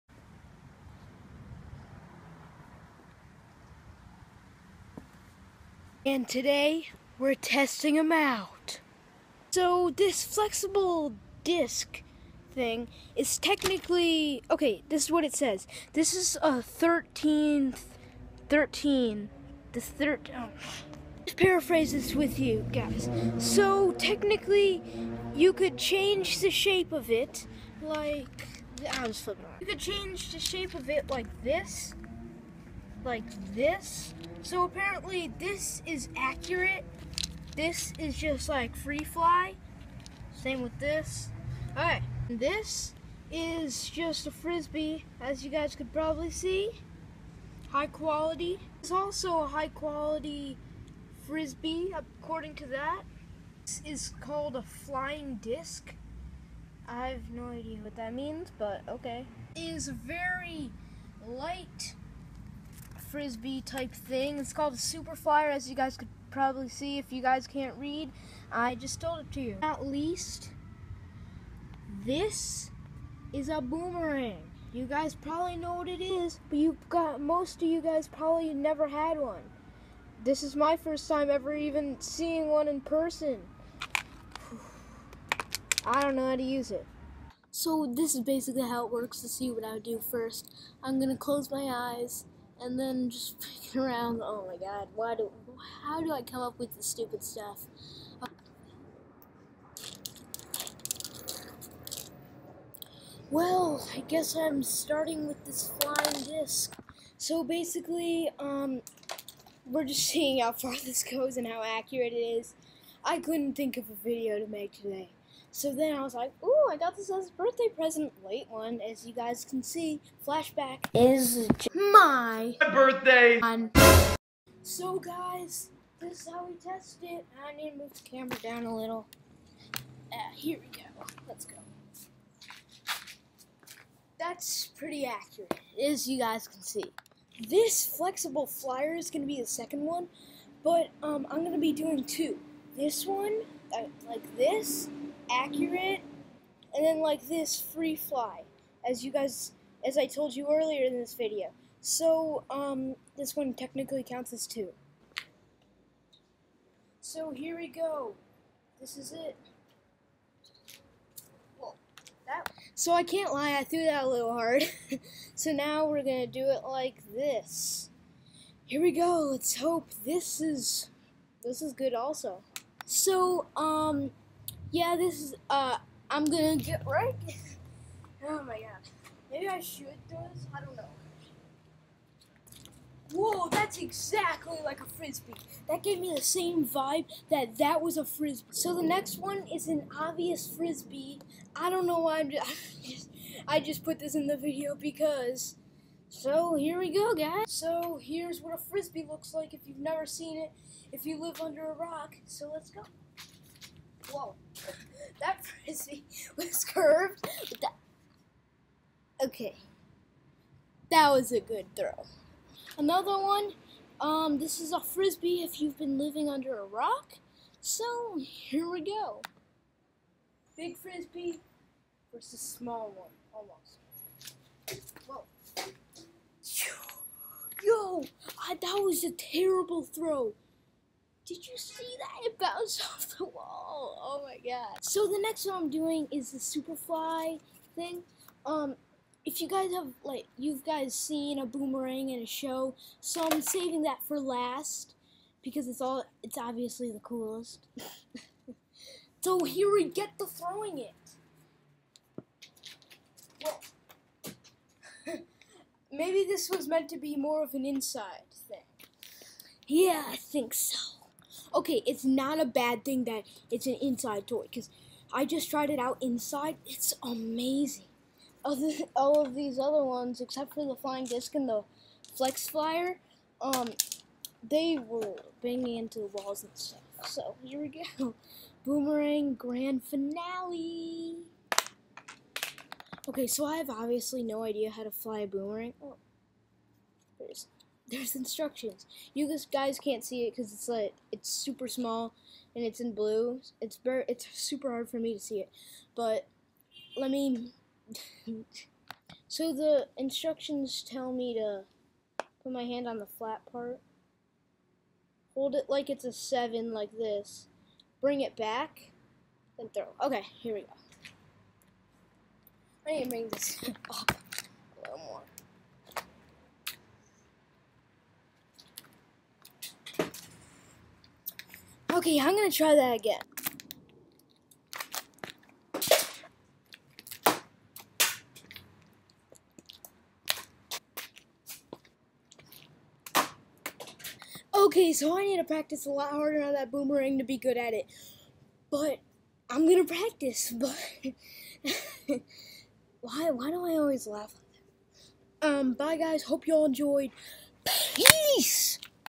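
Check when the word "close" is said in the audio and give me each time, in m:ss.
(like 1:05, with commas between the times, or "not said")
1:31.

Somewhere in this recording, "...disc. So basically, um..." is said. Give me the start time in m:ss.
1:46.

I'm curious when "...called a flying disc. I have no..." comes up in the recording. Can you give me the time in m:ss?
0:54.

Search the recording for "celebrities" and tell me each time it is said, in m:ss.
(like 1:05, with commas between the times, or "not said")
not said.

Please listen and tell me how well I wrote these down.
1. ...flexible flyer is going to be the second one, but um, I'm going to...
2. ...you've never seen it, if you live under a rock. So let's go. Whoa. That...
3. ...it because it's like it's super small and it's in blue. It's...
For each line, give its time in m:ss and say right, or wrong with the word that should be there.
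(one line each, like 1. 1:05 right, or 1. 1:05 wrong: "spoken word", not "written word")
1. 2:17 right
2. 3:19 right
3. 4:50 right.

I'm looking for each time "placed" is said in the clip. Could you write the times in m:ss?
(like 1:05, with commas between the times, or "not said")
not said.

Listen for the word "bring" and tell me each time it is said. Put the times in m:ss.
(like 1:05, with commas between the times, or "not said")
5:07, 5:13.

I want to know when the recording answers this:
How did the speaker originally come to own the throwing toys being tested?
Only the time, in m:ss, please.
1:57.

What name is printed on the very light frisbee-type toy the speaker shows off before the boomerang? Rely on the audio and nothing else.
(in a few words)
Super flyer.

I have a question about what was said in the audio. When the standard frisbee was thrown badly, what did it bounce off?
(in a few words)
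The wall.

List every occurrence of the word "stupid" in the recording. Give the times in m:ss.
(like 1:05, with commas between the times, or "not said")
1:36.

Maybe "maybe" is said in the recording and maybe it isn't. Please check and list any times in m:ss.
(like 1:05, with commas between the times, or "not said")
2:59, 4:15.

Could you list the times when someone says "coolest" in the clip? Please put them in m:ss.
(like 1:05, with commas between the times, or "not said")
4:06.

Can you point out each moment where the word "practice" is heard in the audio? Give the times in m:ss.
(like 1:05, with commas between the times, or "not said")
5:35, 5:39.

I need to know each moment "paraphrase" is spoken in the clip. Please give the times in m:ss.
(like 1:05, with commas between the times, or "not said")
0:21.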